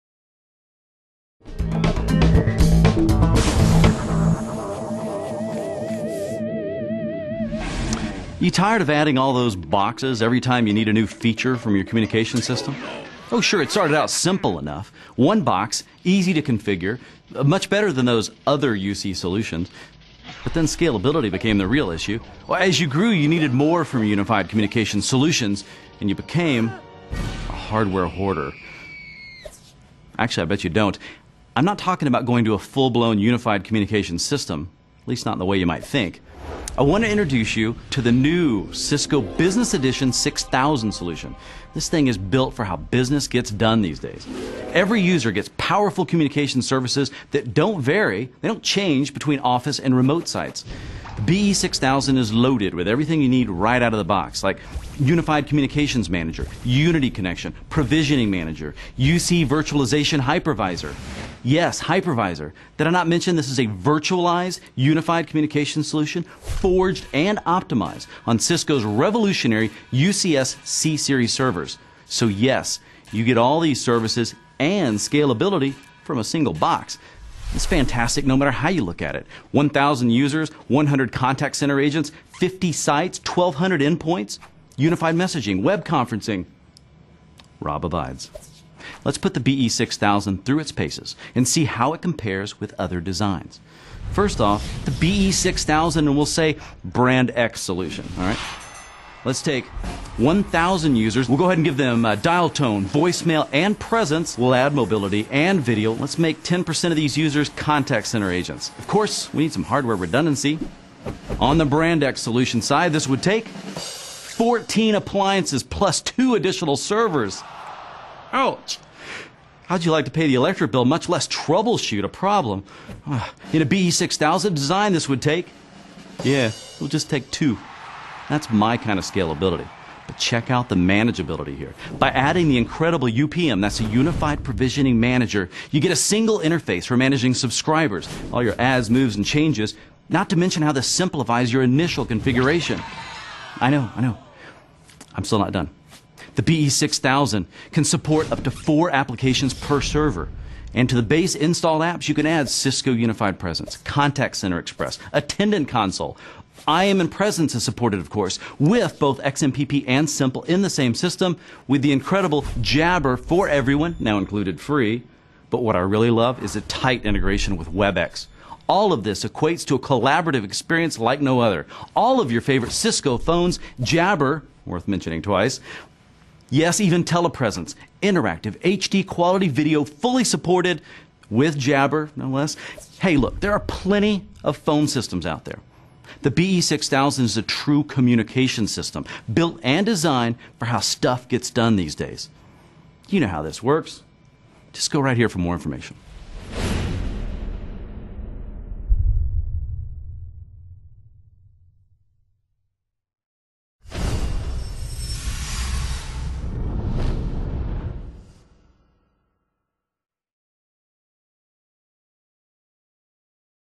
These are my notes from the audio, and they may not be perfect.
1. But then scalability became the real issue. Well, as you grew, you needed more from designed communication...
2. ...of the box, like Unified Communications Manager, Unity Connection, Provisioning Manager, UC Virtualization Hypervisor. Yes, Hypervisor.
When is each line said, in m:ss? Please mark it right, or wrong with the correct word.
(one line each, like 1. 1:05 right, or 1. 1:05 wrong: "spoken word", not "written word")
1. 0:20 wrong: "unified", not "designed"
2. 0:53 right.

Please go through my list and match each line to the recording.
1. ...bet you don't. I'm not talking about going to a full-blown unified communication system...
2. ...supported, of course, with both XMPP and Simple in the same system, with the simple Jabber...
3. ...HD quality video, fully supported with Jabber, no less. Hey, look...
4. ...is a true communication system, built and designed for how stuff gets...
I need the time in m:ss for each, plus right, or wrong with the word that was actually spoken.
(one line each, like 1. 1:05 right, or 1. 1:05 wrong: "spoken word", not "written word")
1. 0:30 right
2. 2:37 wrong: "incredible", not "simple"
3. 2:58 right
4. 3:07 right.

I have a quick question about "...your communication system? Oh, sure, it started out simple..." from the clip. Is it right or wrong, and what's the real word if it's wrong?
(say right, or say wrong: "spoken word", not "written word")
right.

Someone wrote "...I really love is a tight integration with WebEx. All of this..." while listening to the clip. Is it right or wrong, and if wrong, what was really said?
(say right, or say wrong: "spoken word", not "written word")
right.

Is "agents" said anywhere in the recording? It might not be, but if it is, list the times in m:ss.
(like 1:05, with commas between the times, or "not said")
1:21, 1:48.